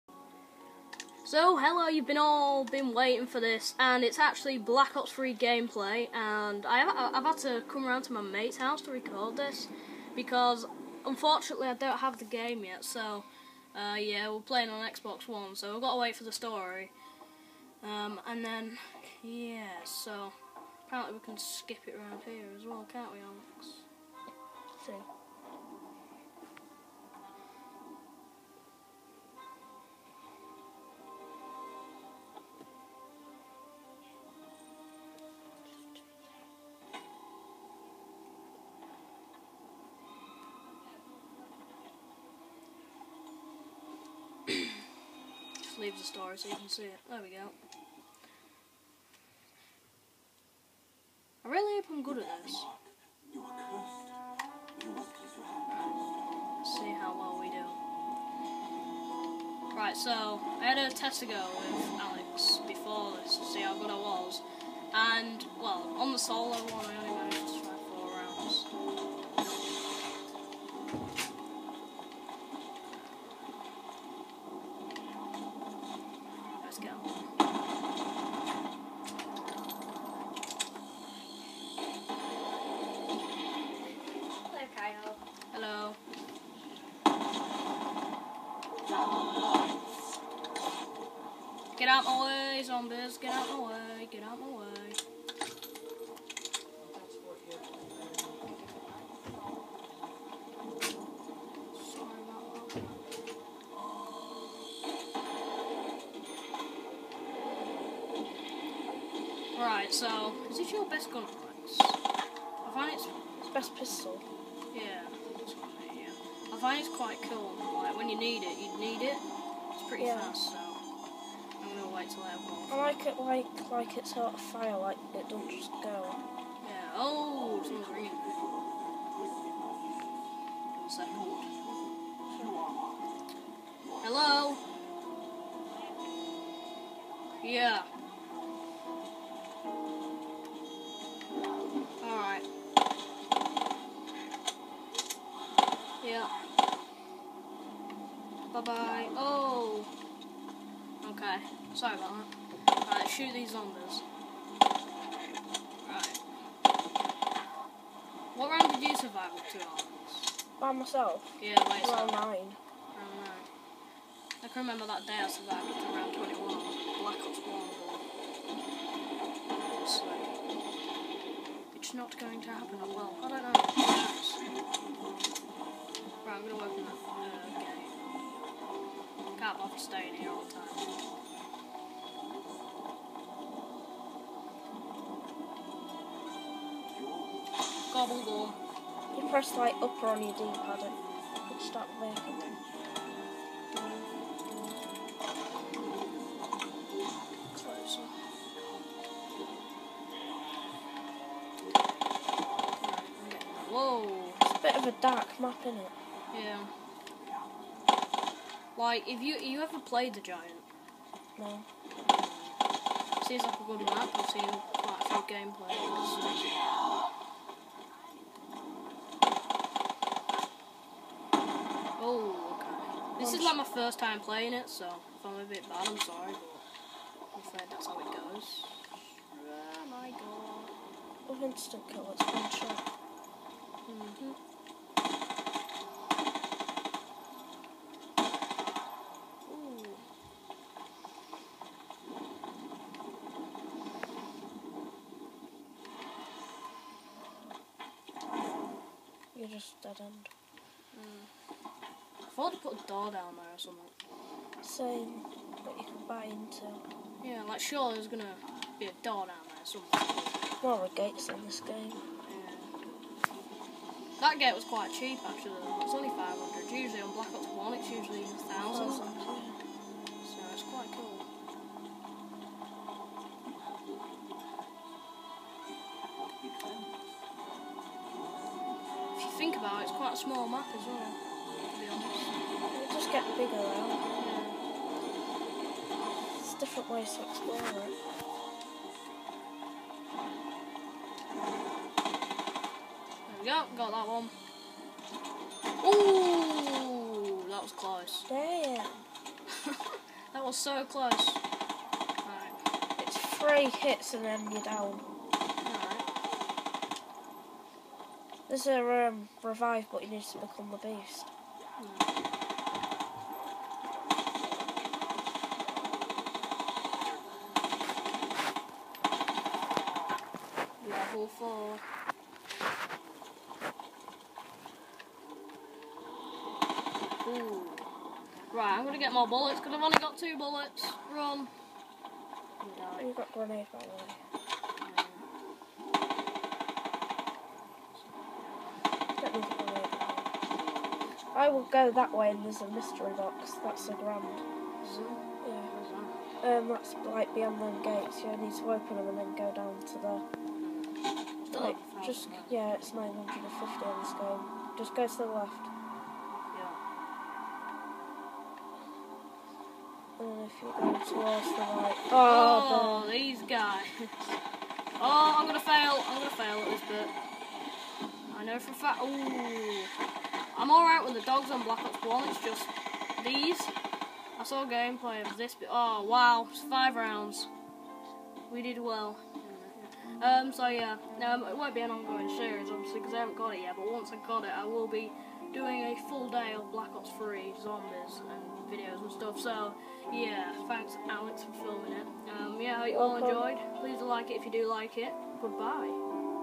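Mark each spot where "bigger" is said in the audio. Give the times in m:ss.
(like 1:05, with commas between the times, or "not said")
4:43.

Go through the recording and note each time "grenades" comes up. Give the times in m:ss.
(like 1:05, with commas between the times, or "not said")
5:33.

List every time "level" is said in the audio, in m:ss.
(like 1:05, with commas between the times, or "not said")
5:20.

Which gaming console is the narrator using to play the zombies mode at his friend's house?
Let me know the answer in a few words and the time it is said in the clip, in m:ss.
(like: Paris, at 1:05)
Xbox One, at 0:14.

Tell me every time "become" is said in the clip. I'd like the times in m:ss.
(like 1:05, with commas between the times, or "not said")
5:10.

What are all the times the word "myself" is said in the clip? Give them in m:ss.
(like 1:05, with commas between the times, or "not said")
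2:40.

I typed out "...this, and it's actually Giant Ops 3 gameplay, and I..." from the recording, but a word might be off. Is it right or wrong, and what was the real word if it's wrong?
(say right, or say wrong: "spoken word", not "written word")
wrong: "Black", not "Giant".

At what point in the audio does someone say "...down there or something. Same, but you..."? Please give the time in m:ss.
4:13.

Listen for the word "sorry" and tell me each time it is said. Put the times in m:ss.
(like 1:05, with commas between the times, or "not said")
2:31, 3:45.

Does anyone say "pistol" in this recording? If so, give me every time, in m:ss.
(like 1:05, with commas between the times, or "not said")
1:53.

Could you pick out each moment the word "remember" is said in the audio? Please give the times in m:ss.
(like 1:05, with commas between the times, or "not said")
2:44.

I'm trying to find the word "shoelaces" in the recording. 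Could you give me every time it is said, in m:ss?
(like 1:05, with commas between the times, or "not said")
not said.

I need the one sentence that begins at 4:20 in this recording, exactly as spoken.
More of gates in this game.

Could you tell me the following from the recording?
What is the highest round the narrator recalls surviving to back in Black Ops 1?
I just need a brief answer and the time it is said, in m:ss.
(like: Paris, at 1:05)
21, at 2:45.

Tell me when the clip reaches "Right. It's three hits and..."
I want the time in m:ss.
5:02.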